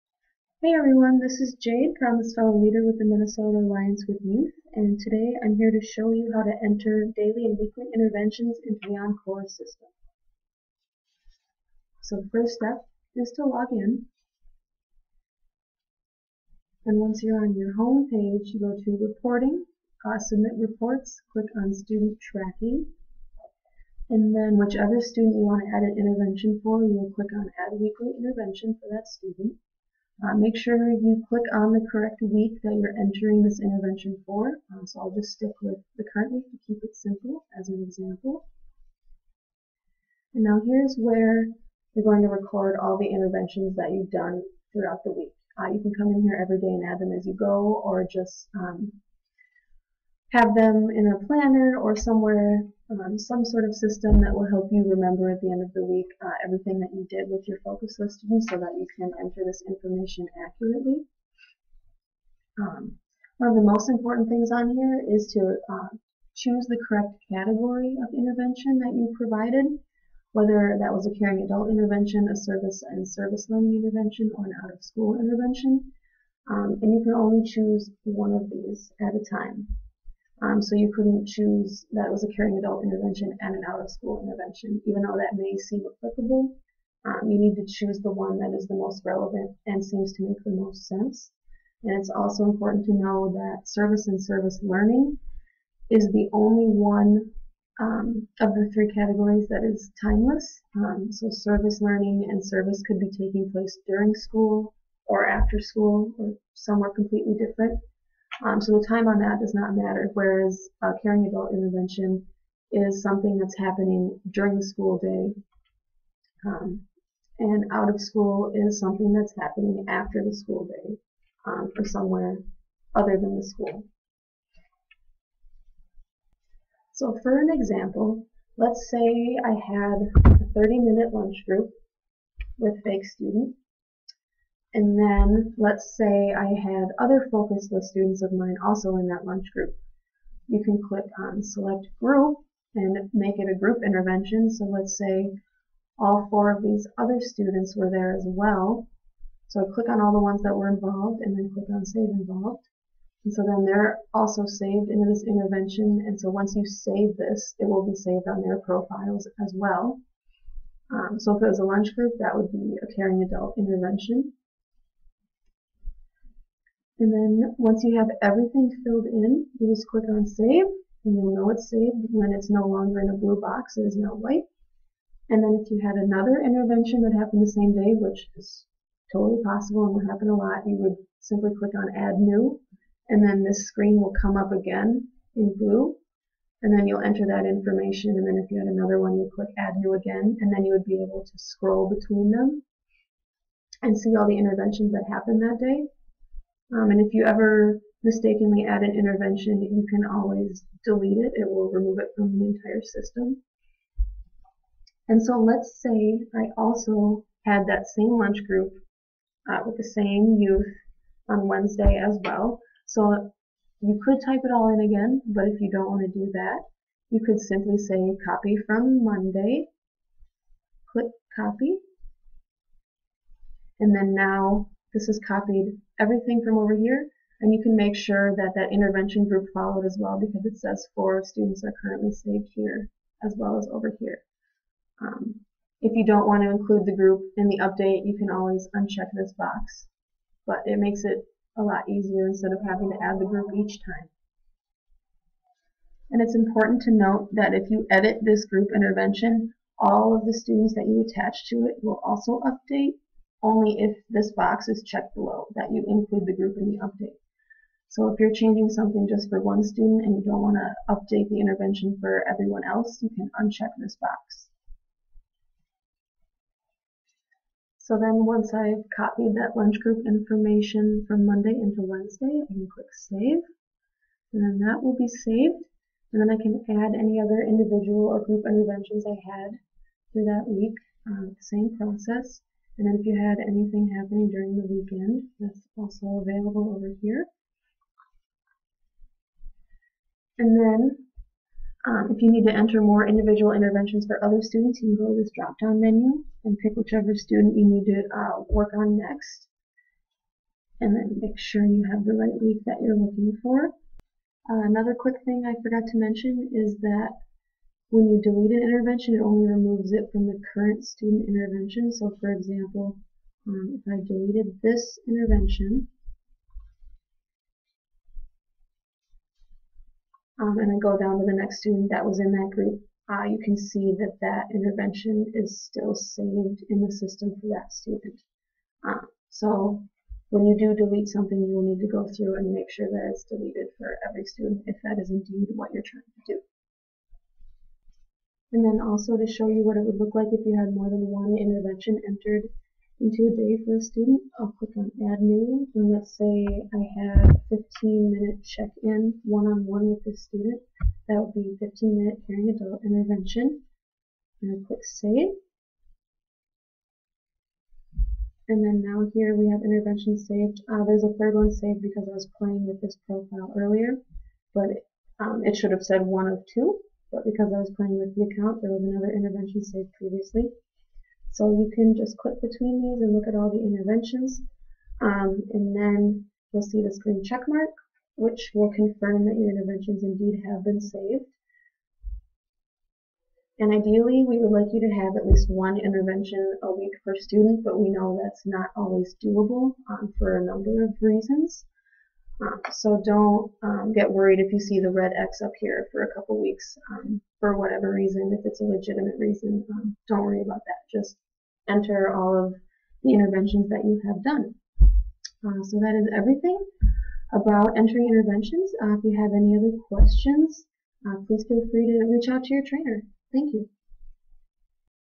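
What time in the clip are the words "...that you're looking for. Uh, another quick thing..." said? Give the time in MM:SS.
05:02.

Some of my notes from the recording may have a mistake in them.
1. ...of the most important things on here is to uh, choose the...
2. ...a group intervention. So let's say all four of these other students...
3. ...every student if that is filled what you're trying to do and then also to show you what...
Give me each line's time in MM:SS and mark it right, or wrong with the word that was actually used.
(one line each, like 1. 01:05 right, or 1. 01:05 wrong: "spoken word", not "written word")
1. 01:03 right
2. 02:23 right
3. 05:34 wrong: "indeed", not "filled".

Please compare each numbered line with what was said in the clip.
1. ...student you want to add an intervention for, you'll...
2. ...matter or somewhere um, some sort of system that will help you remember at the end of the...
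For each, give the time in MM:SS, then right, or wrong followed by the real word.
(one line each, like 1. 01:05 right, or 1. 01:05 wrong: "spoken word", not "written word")
1. 00:25 right
2. 00:51 wrong: "planner", not "matter".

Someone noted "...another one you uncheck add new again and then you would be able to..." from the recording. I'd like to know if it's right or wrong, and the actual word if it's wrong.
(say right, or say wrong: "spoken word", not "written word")
wrong: "click", not "uncheck".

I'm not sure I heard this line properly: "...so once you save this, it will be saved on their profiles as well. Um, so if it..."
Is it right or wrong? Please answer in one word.
right.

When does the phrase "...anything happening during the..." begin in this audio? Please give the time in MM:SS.
04:43.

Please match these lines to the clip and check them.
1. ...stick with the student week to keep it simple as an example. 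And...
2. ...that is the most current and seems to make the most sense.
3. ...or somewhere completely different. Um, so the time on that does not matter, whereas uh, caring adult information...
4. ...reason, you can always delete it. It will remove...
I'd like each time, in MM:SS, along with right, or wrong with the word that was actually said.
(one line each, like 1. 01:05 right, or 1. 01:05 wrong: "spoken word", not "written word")
1. 00:35 wrong: "current", not "student"
2. 01:28 wrong: "relevant", not "current"
3. 01:46 wrong: "intervention", not "information"
4. 03:18 wrong: "intervention", not "reason".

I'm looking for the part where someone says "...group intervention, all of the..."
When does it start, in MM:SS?
04:08.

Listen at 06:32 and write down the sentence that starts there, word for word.
Um, so don't um, get worried if you see the red X up here for a couple weeks um, for whatever reason.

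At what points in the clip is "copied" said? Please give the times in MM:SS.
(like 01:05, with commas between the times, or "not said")
03:45, 04:28.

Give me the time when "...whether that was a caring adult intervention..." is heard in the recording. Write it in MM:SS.
01:10.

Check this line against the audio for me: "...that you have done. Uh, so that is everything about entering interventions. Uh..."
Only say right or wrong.
right.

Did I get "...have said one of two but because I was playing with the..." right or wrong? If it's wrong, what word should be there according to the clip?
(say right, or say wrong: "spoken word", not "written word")
right.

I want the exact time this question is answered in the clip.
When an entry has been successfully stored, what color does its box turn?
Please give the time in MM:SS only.
02:54.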